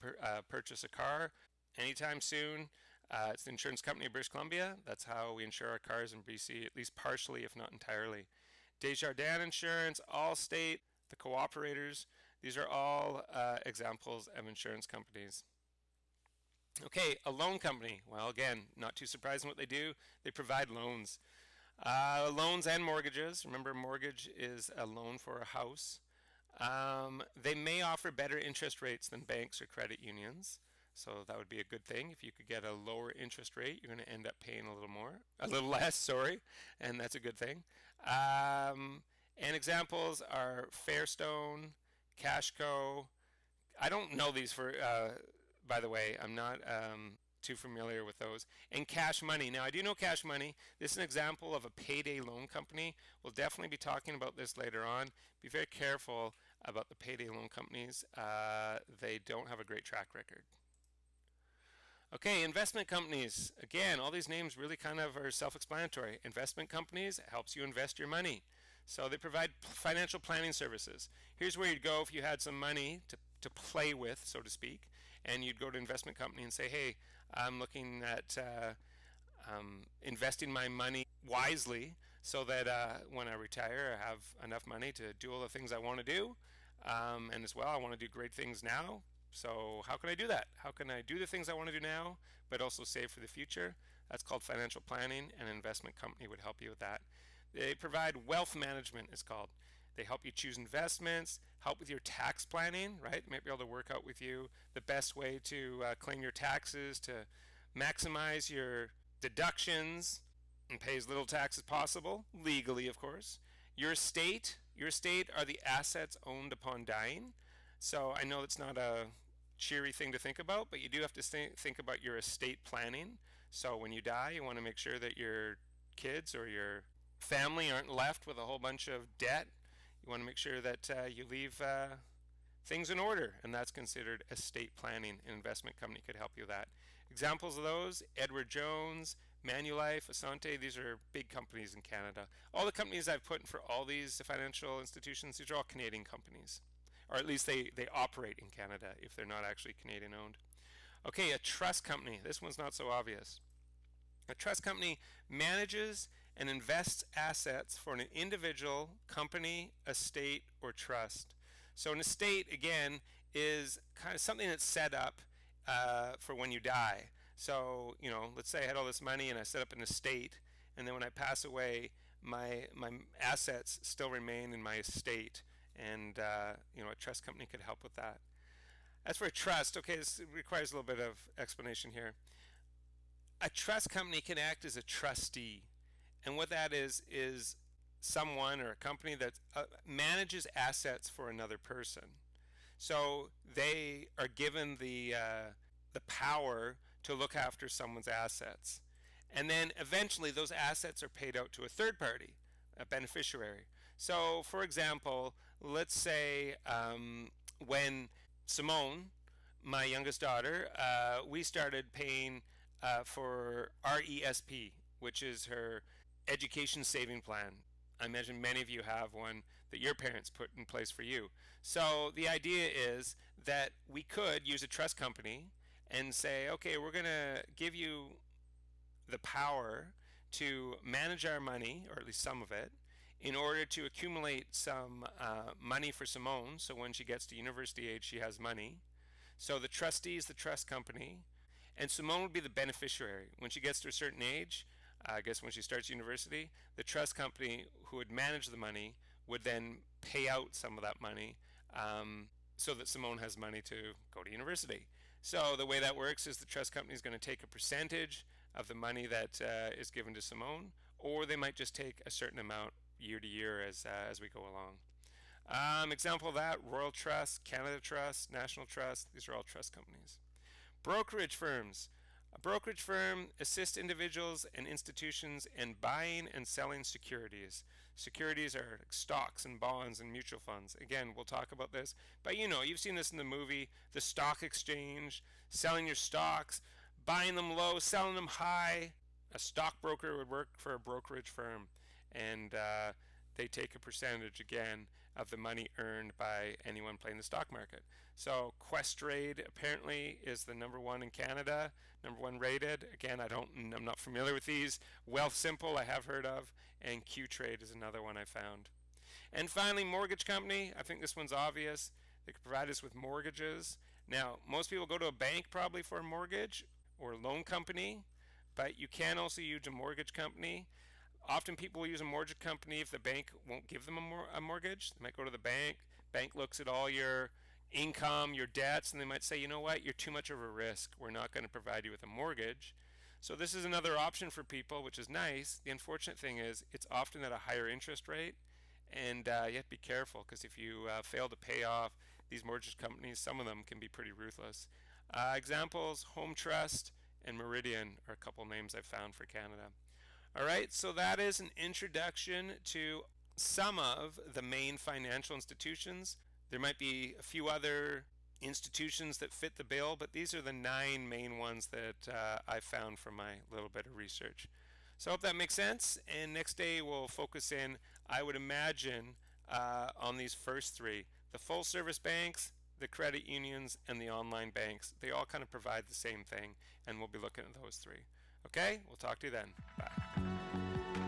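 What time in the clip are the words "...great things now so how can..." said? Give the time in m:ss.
1:28.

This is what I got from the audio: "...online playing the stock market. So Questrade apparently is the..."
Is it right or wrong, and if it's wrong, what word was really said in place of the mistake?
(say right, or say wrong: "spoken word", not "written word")
wrong: "anyone", not "online".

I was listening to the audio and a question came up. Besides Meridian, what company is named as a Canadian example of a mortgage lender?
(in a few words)
Home Trust.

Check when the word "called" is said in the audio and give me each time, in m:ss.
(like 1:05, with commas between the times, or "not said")
1:34, 1:39.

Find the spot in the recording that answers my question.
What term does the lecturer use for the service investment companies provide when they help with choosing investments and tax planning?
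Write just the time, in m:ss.
1:38.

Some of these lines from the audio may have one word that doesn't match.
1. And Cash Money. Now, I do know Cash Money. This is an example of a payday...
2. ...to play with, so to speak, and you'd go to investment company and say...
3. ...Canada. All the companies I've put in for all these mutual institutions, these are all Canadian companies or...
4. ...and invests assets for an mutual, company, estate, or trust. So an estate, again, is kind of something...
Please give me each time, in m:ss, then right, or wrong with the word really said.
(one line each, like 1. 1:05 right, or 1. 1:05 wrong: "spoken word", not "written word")
1. 0:48 right
2. 1:13 right
3. 2:21 wrong: "financial", not "mutual"
4. 2:36 wrong: "individual", not "mutual".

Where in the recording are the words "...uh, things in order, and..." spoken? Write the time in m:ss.
2:11.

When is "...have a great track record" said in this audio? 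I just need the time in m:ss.
0:59.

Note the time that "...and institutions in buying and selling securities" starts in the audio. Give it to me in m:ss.
4:34.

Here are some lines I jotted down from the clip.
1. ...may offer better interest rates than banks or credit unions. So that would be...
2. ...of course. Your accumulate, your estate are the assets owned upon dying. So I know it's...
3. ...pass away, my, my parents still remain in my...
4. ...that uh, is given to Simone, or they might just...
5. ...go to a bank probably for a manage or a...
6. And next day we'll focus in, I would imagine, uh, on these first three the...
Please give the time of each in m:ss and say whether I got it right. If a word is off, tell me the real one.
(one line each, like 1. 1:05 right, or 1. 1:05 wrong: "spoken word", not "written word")
1. 0:27 right
2. 1:52 wrong: "estate", not "accumulate"
3. 2:51 wrong: "assets", not "parents"
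4. 4:19 right
5. 5:14 wrong: "mortgage", not "manage"
6. 6:06 right.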